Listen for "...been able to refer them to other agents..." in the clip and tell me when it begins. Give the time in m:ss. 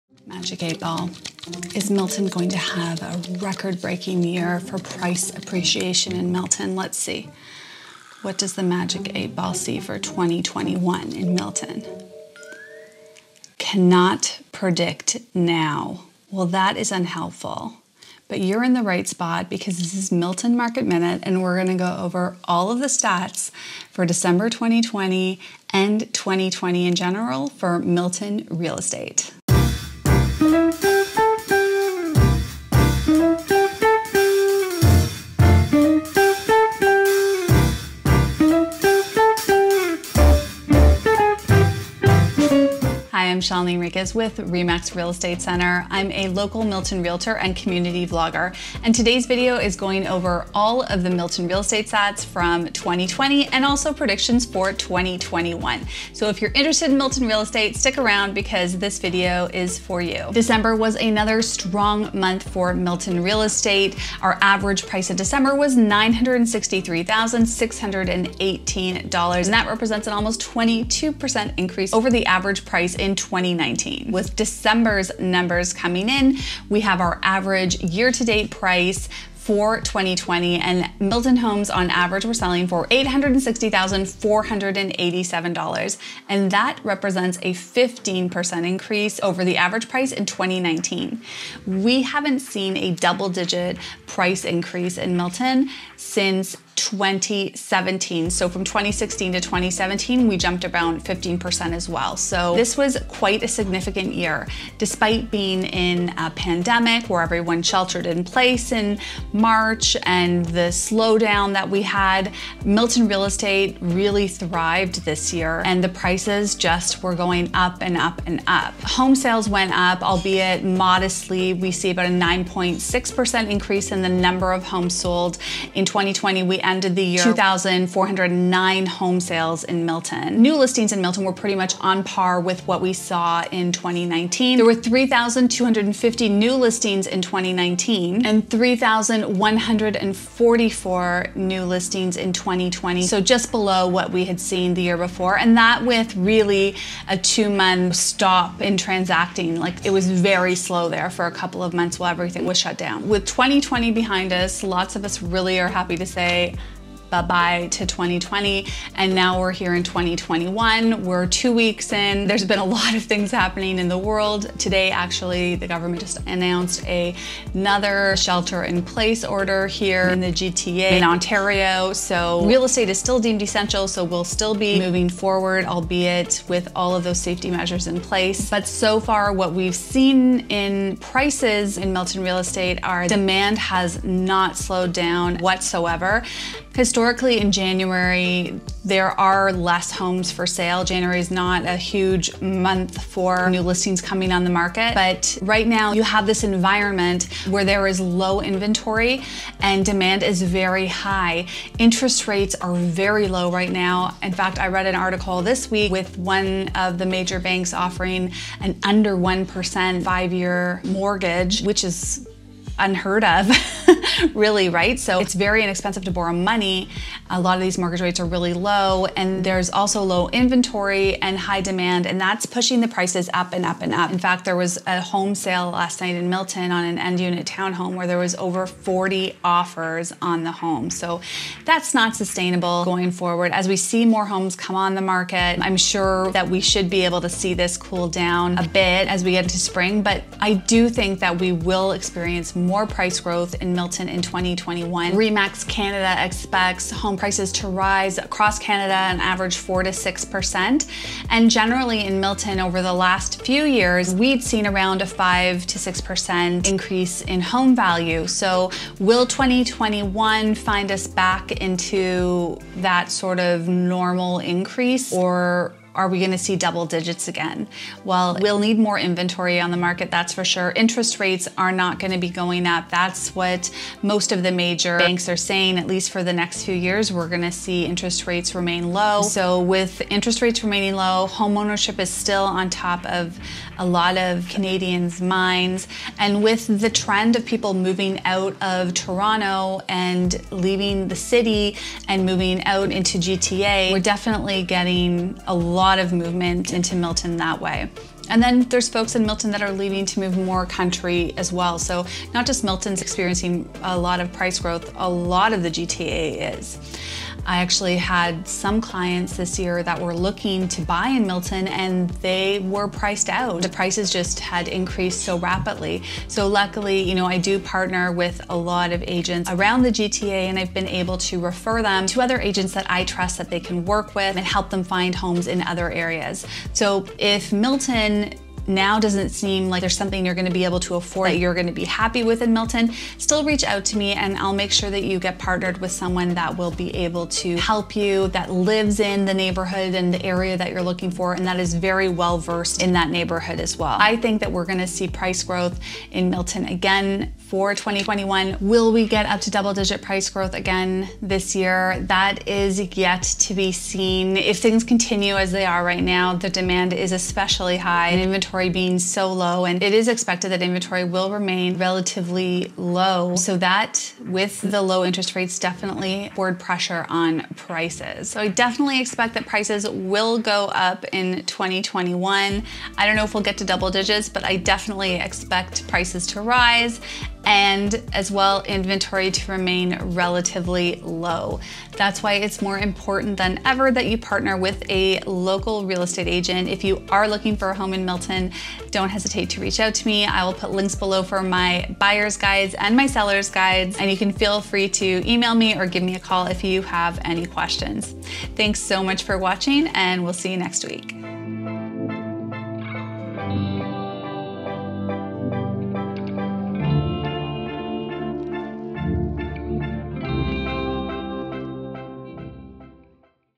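5:20.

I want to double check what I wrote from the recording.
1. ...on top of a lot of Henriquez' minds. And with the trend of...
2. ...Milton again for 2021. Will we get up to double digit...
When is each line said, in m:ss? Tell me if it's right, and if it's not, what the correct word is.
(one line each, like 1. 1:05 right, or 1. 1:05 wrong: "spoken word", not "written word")
1. 4:42 wrong: "Canadians", not "Henriquez"
2. 5:46 right.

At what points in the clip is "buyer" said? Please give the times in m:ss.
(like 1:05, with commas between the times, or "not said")
6:31.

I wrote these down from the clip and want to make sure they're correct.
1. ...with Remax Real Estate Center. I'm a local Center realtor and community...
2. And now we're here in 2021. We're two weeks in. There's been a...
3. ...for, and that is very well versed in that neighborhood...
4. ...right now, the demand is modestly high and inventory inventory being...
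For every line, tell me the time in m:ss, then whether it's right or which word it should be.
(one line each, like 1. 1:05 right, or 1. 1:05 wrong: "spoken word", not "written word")
1. 0:44 wrong: "Milton", not "Center"
2. 2:38 right
3. 5:41 right
4. 5:55 wrong: "especially", not "modestly".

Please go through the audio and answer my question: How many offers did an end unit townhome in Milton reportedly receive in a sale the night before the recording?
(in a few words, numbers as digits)
over 40.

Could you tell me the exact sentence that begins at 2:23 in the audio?
So just below what we had seen the year before.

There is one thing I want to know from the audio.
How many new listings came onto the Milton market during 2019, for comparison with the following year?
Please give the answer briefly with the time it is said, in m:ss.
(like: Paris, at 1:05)
3,250, at 2:14.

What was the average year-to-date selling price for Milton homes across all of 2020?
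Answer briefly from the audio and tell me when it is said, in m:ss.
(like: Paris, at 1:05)
$860,487, at 1:22.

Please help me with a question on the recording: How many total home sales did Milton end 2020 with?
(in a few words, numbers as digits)
2,409.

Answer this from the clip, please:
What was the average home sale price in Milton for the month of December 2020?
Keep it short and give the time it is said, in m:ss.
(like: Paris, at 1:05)
$963,618, at 1:05.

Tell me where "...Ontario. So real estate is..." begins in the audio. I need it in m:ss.
2:51.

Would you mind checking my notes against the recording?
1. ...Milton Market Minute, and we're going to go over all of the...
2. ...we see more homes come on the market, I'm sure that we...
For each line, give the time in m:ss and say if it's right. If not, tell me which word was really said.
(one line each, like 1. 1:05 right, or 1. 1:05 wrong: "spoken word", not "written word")
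1. 0:20 right
2. 3:53 right.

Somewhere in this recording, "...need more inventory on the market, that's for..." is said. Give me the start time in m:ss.
4:28.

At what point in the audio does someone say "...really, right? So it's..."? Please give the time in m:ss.
3:34.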